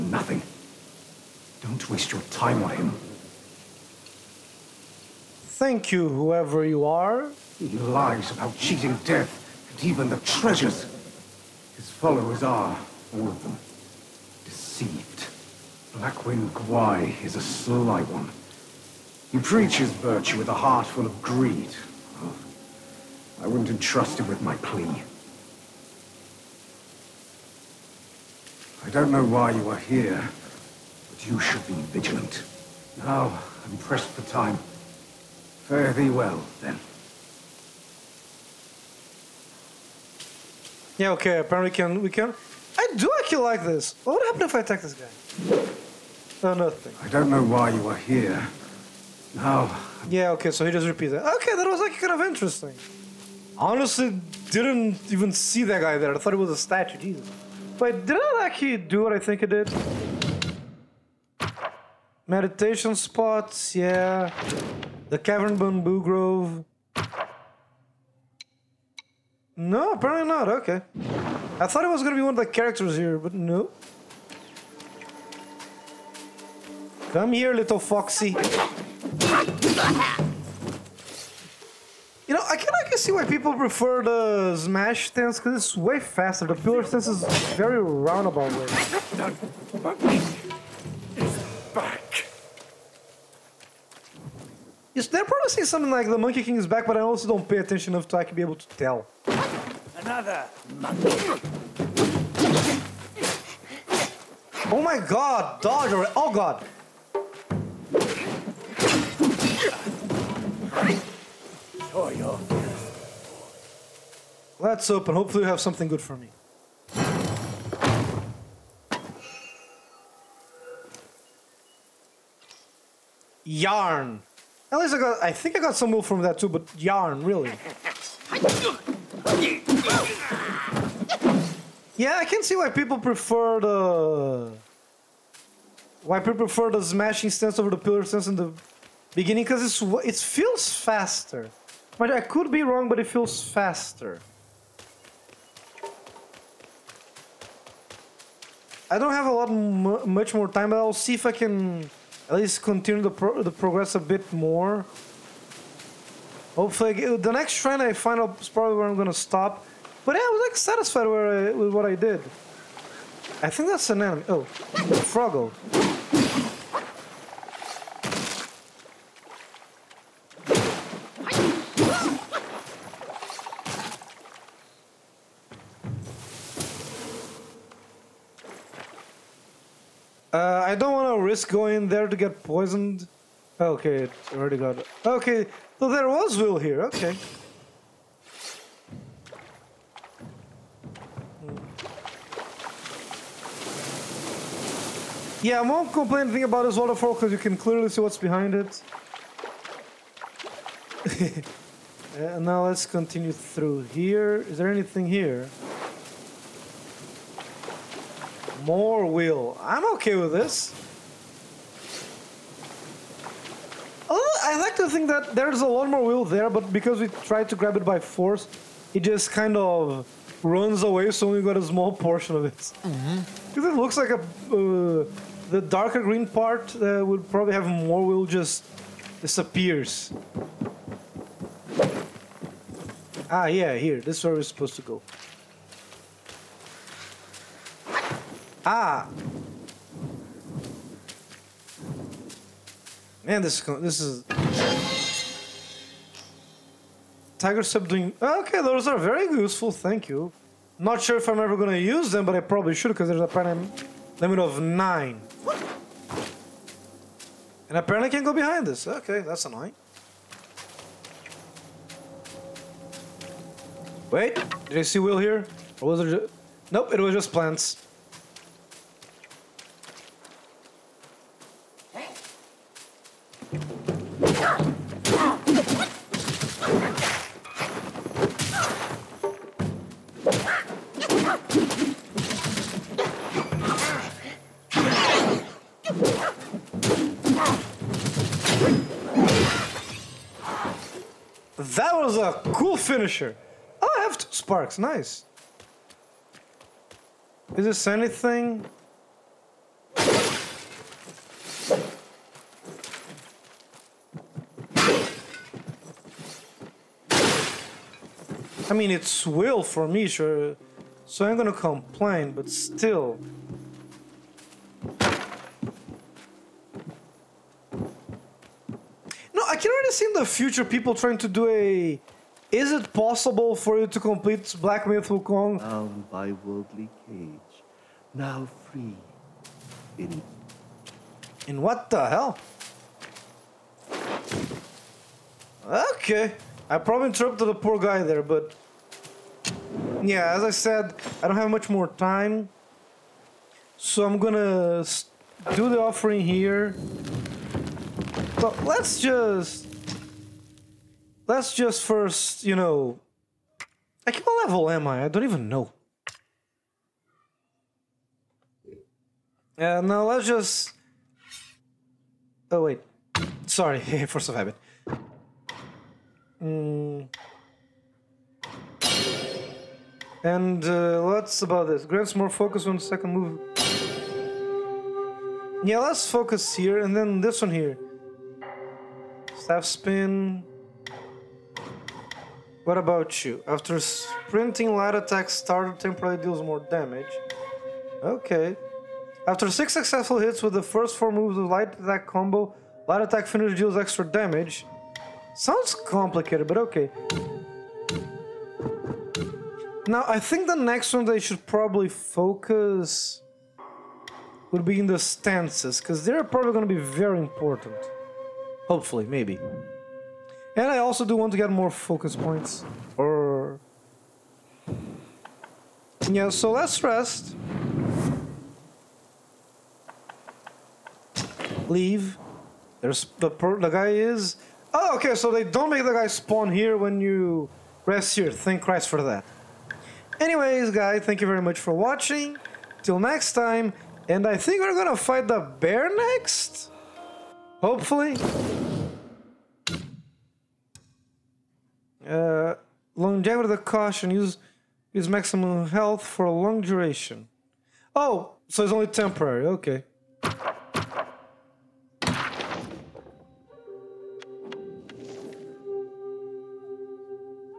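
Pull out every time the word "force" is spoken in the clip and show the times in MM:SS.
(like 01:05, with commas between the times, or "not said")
03:37, 06:04.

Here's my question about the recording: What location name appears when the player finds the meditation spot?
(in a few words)
Cavern Bamboo Grove.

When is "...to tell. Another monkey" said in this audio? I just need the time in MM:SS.
01:38.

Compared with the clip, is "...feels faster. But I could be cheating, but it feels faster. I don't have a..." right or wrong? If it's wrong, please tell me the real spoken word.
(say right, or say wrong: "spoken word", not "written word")
wrong: "wrong", not "cheating".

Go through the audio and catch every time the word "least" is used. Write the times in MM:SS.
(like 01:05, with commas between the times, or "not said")
02:04, 02:32.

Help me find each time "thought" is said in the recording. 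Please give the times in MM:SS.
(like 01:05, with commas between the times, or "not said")
00:56, 01:11.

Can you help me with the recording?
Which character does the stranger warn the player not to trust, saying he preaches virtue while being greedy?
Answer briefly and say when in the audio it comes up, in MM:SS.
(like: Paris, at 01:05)
Blackwind Guai, at 00:15.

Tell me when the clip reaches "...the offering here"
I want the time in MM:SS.
05:45.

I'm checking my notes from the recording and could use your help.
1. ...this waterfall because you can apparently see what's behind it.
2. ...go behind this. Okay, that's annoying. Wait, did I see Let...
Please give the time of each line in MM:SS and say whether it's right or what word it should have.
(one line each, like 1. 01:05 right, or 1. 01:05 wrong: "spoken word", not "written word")
1. 03:16 wrong: "clearly", not "apparently"
2. 04:18 wrong: "Will", not "Let".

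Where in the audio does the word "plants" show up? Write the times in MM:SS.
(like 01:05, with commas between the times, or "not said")
04:27.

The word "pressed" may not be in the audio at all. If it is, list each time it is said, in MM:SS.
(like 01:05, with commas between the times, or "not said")
00:33.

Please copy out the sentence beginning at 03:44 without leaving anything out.
Uh, the darker green part uh, would probably have more wheel just disappears.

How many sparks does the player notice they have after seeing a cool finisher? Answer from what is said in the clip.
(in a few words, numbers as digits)
2.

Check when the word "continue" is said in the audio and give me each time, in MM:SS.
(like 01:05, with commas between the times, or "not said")
02:32, 03:22.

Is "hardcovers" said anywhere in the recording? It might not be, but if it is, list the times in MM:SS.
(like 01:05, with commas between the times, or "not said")
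not said.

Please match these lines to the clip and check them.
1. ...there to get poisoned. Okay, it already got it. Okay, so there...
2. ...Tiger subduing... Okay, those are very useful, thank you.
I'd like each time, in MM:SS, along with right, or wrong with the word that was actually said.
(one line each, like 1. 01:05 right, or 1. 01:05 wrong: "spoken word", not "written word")
1. 03:01 right
2. 04:07 right.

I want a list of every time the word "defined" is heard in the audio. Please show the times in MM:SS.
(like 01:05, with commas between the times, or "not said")
not said.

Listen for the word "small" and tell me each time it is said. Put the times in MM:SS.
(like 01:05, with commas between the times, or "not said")
03:41.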